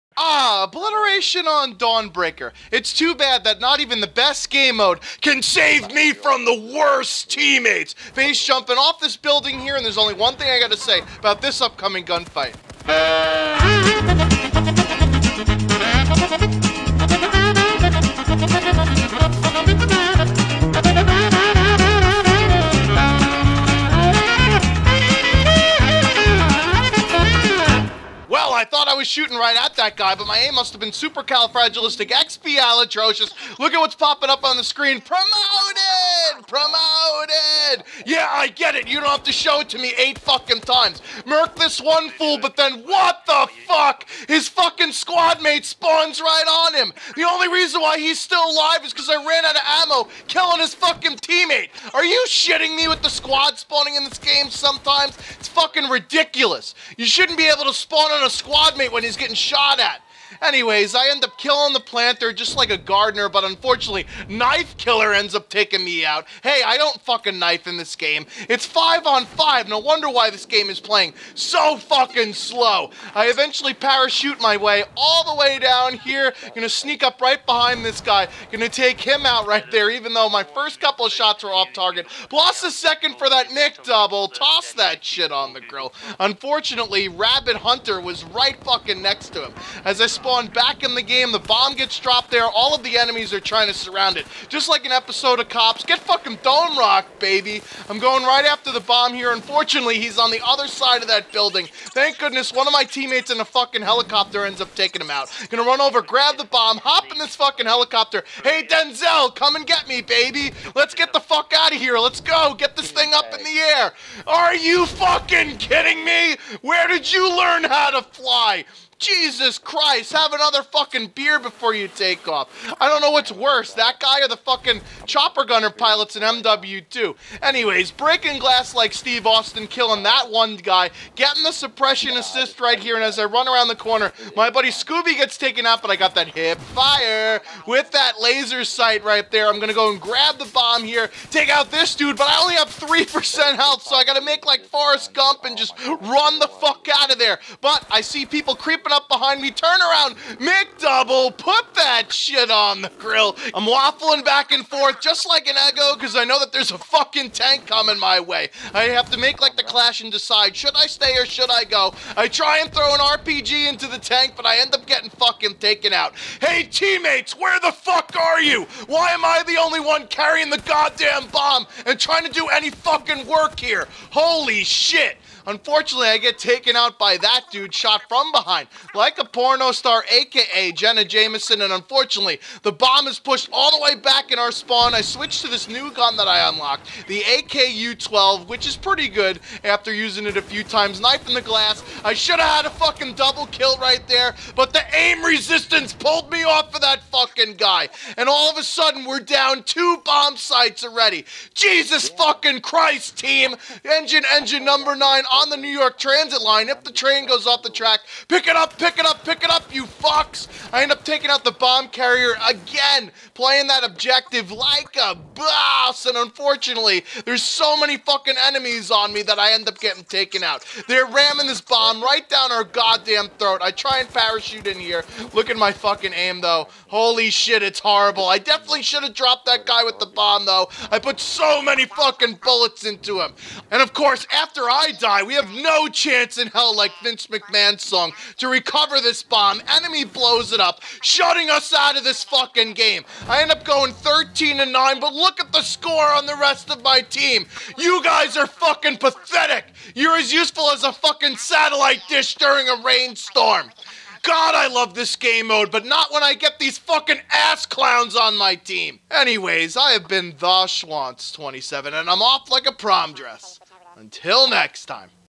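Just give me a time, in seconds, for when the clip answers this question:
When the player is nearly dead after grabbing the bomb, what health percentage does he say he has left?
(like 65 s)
142 s.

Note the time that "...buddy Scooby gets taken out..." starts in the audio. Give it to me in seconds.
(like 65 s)
134 s.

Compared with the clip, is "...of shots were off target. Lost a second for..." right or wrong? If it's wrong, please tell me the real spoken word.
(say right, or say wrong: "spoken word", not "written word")
right.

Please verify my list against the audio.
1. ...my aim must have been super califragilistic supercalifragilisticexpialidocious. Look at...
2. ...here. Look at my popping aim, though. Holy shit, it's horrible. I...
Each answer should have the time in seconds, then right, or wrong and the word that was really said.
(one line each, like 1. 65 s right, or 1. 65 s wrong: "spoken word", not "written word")
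1. 30 s right
2. 224 s wrong: "fucking", not "popping".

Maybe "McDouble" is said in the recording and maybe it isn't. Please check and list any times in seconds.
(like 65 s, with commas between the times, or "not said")
83 s, 150 s.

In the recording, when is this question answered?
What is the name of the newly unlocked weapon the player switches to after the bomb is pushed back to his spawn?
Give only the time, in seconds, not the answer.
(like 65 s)
187 s.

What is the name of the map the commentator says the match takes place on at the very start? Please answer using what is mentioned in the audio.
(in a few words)
Dawnbreaker.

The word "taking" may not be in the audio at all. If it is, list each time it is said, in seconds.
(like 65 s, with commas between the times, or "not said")
65 s, 104 s, 211 s.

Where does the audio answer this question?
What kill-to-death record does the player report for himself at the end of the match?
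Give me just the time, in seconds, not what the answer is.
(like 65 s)
243 s.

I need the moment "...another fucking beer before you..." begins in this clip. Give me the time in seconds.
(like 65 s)
120 s.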